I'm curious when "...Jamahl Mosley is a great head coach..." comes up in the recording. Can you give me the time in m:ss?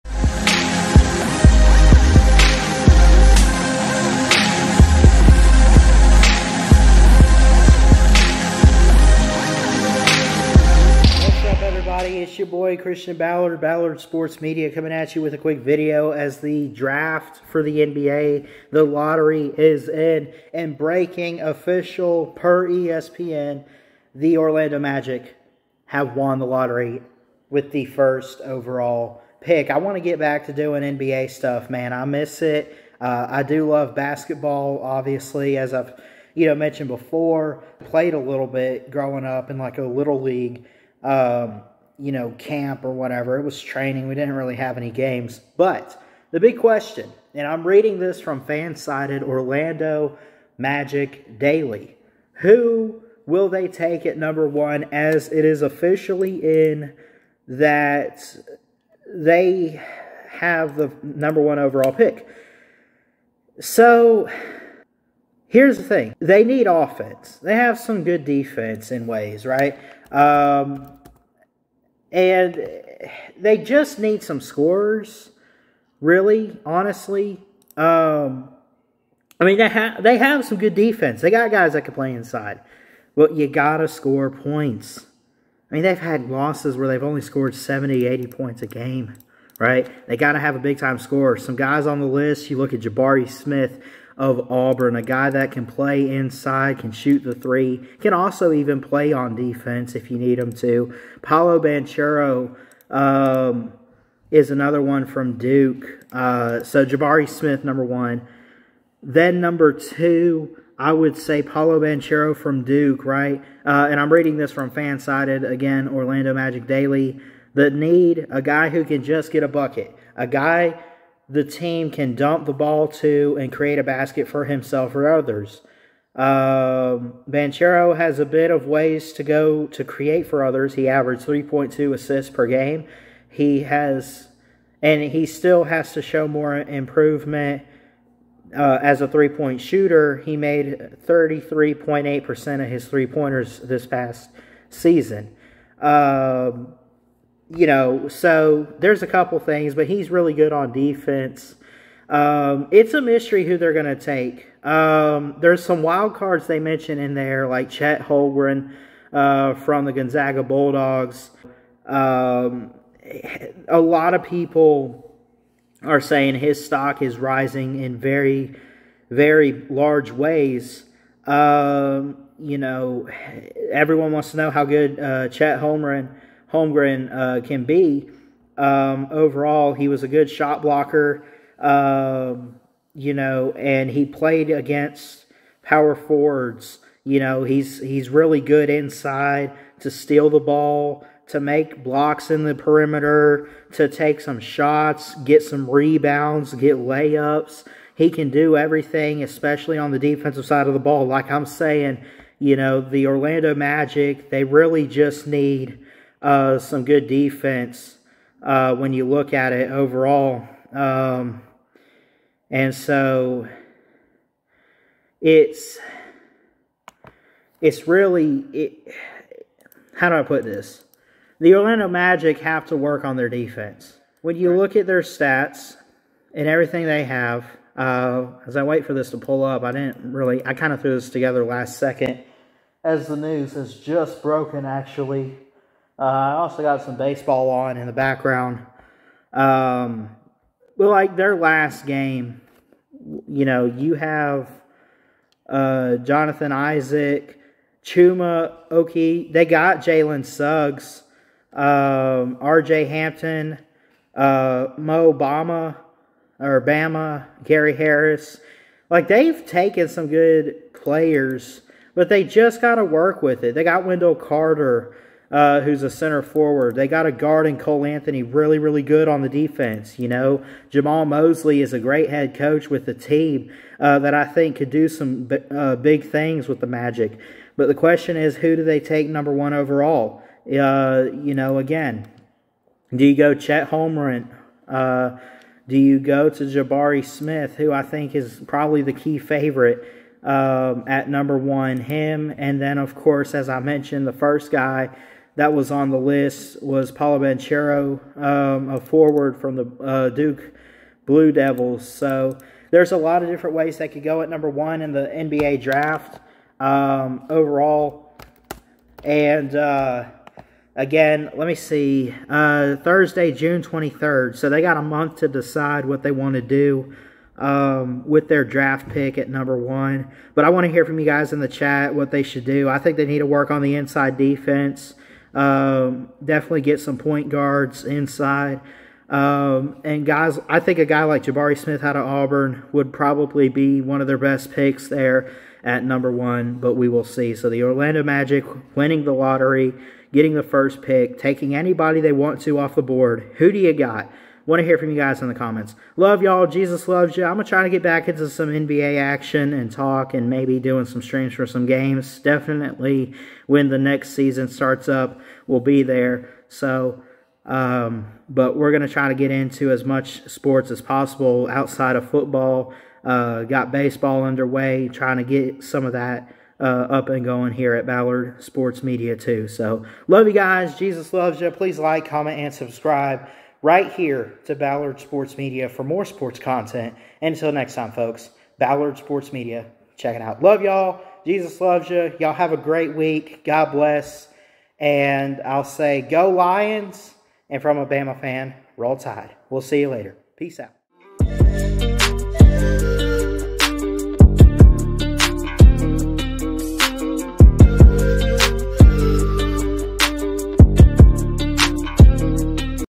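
4:30.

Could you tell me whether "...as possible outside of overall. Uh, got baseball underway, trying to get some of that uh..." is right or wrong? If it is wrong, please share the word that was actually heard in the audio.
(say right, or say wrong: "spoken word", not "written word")
wrong: "football", not "overall".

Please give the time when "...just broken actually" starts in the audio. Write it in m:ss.
3:53.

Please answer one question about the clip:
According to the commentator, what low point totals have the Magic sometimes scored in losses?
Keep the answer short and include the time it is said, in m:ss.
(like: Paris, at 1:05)
70, 80 points, at 1:27.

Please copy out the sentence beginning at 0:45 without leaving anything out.
But the big question, and I'm reading this from Fansided Orlando Magic Daily.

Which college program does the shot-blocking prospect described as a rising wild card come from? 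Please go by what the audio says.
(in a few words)
Gonzaga.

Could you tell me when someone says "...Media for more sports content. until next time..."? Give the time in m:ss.
6:15.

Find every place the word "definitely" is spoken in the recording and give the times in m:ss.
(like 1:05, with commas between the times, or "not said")
5:26, 5:52.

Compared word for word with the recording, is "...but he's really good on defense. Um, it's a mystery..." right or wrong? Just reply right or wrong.
right.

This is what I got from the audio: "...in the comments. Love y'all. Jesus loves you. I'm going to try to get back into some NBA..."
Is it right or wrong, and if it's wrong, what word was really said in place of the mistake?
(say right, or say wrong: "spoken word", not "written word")
right.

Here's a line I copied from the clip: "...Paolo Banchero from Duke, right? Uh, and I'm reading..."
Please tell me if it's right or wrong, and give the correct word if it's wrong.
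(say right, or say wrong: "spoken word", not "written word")
right.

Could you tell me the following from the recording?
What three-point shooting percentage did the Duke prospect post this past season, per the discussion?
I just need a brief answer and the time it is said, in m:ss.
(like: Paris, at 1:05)
33.8%, at 2:21.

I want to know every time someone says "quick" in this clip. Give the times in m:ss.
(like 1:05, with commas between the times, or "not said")
0:15.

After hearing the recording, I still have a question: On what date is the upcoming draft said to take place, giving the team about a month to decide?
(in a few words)
Thursday, June 23rd.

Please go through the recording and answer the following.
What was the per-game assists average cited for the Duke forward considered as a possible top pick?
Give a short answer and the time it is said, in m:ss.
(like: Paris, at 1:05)
3.2, at 2:11.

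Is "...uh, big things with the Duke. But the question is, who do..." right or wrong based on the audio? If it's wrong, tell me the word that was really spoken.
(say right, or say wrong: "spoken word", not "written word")
wrong: "Magic", not "Duke".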